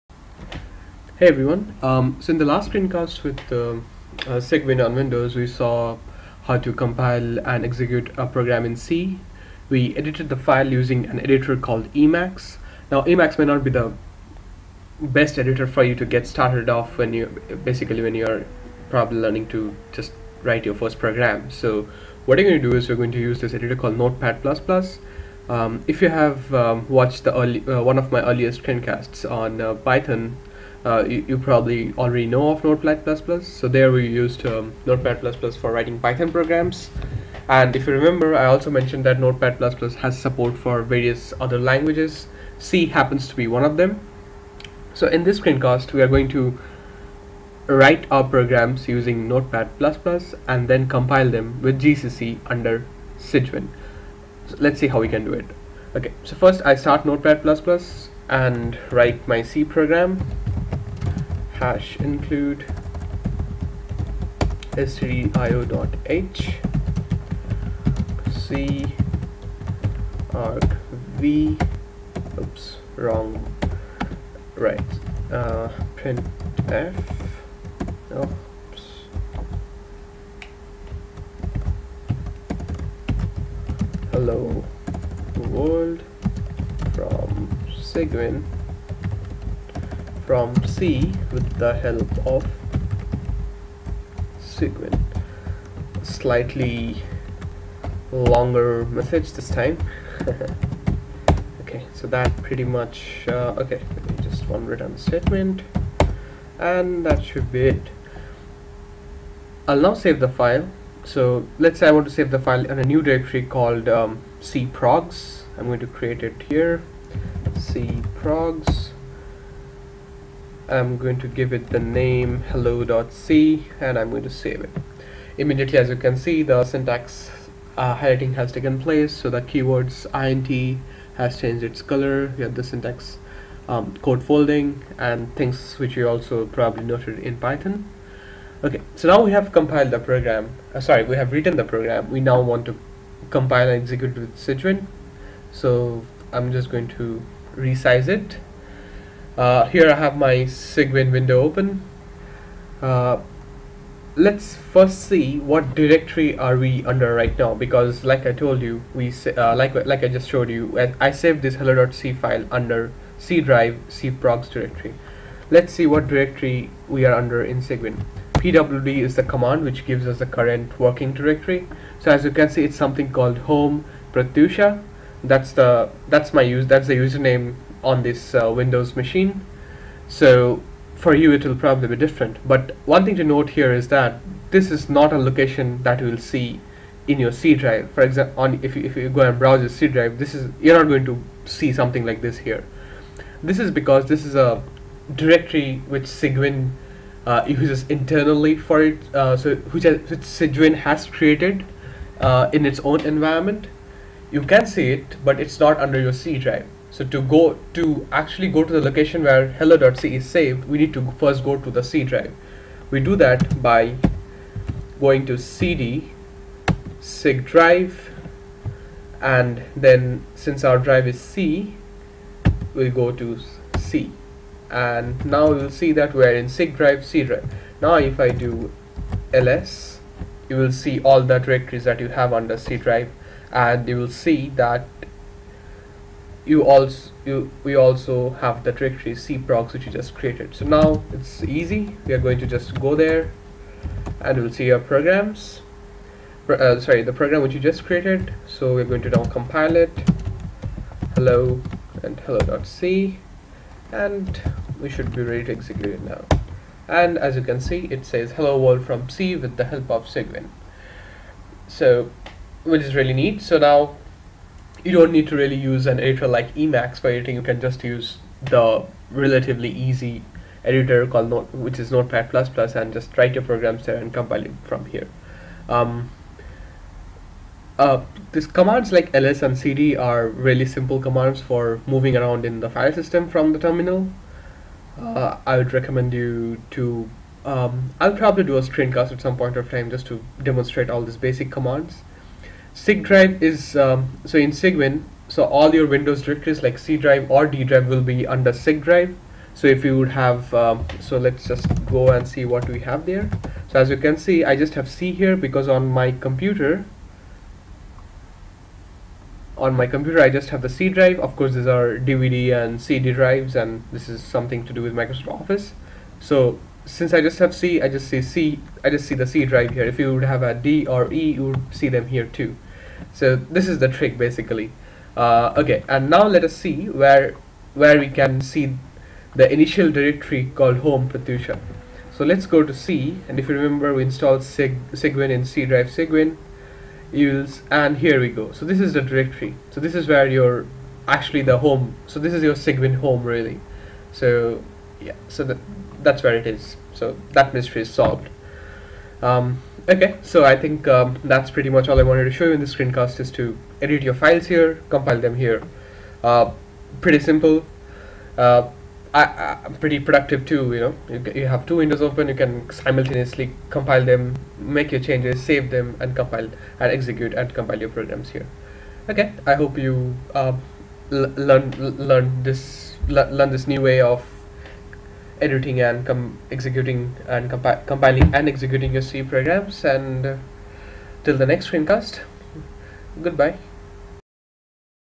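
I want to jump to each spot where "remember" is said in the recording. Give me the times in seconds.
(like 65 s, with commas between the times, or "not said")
37 s, 333 s.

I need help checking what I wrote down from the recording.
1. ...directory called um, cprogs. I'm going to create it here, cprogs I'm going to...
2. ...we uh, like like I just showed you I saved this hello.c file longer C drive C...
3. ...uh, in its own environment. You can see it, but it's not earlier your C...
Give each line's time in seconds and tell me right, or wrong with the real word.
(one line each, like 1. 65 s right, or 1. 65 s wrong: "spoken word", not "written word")
1. 113 s right
2. 158 s wrong: "under", not "longer"
3. 202 s wrong: "under", not "earlier".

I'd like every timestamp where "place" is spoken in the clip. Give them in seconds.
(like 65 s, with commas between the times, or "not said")
128 s.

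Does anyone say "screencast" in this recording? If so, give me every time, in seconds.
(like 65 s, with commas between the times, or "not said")
2 s, 28 s, 45 s, 288 s, 352 s, 381 s.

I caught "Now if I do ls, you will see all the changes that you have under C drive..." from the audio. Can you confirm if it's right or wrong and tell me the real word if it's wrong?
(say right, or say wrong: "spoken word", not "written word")
wrong: "directories", not "changes".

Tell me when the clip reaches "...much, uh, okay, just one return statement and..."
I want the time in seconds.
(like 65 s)
102 s.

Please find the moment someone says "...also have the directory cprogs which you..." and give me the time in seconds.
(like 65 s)
237 s.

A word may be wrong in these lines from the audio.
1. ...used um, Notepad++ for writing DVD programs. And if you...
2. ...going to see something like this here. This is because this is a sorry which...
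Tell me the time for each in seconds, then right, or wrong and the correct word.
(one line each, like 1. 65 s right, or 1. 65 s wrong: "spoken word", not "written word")
1. 34 s wrong: "Python", not "DVD"
2. 190 s wrong: "directory", not "sorry".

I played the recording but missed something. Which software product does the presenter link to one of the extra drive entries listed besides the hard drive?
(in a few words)
Microsoft Office.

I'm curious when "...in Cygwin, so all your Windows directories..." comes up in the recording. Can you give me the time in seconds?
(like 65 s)
294 s.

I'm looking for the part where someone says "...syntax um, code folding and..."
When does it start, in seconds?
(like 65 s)
132 s.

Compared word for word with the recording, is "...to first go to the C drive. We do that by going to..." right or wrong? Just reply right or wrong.
right.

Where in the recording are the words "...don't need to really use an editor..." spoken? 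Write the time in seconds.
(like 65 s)
264 s.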